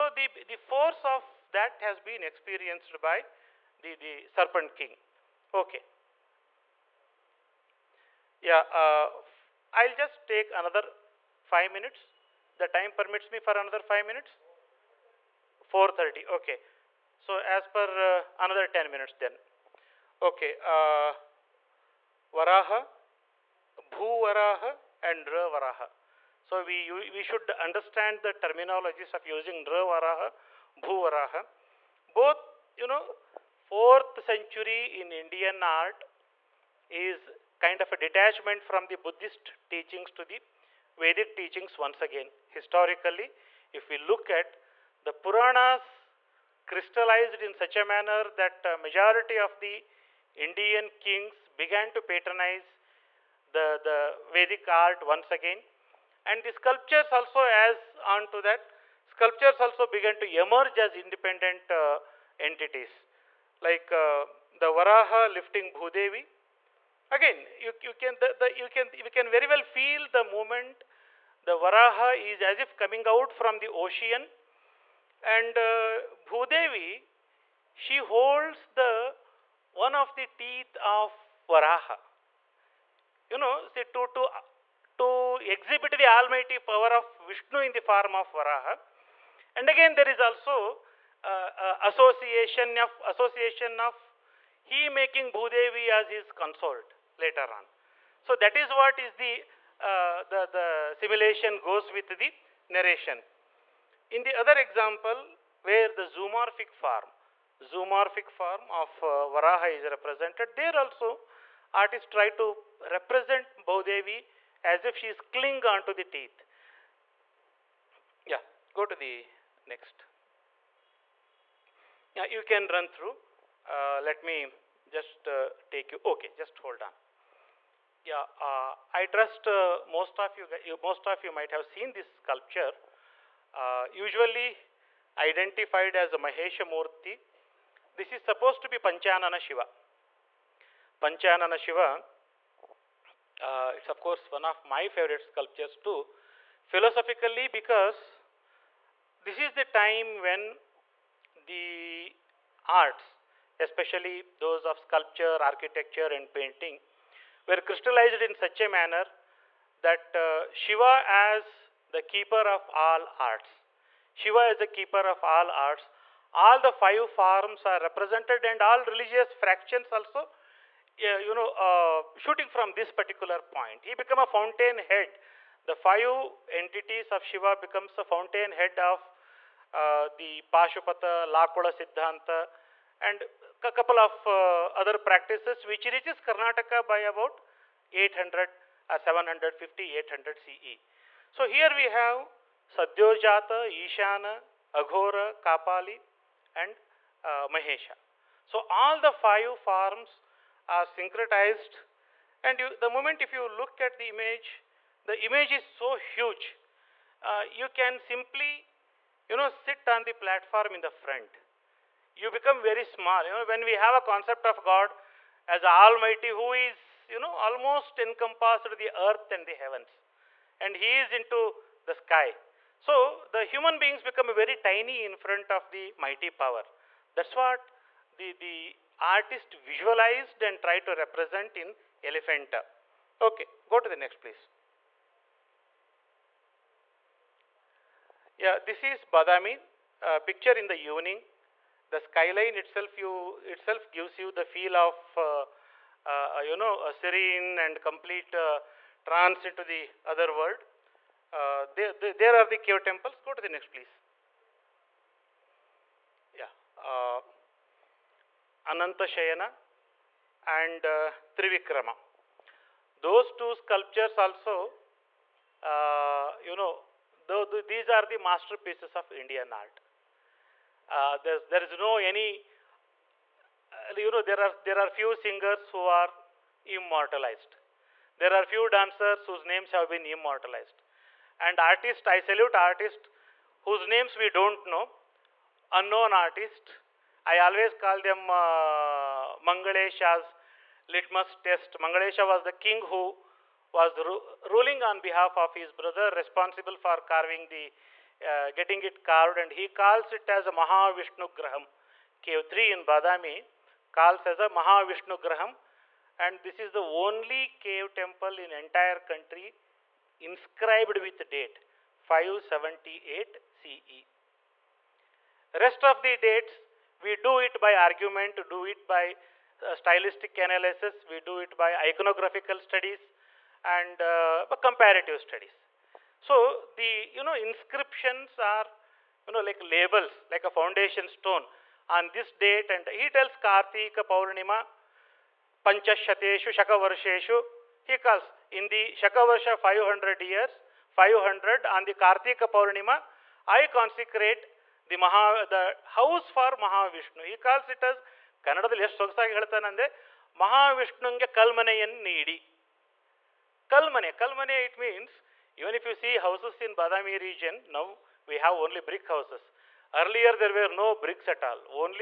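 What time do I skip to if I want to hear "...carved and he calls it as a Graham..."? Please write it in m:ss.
4:59.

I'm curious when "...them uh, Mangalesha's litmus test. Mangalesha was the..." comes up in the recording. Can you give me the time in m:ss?
4:47.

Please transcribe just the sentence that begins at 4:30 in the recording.
Uh, there's, there is no any, uh, you know, there are, there are few singers who are immortalized.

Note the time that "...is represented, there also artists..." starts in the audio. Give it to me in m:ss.
1:49.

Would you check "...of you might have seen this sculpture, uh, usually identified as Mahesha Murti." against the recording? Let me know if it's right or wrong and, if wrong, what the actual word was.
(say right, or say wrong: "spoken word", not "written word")
right.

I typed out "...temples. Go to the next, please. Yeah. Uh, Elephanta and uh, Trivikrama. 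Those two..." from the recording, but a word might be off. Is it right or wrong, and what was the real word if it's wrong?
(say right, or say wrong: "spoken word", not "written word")
wrong: "Shayana", not "Elephanta".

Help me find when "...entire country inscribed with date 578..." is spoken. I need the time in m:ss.
5:08.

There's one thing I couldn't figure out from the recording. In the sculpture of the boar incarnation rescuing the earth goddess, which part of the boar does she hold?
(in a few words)
One of the teeth.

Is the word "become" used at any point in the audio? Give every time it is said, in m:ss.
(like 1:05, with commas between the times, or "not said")
2:57, 3:32, 3:44.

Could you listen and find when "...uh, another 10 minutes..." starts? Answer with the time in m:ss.
0:18.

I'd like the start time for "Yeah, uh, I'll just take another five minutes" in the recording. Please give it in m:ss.
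0:08.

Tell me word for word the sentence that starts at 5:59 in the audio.
Earlier there were no bricks at all.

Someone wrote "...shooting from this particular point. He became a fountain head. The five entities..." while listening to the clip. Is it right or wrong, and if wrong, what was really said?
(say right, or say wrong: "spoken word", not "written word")
right.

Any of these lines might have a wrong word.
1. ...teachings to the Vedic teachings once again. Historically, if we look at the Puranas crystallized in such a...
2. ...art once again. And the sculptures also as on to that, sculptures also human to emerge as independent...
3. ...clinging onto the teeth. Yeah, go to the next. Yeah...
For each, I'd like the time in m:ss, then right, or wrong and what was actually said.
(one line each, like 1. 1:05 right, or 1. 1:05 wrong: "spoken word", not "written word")
1. 0:39 right
2. 0:54 wrong: "began", not "human"
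3. 1:55 right.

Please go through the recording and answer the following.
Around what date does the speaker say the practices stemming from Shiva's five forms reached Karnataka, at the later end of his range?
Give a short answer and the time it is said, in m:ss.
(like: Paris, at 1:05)
800 CE, at 3:09.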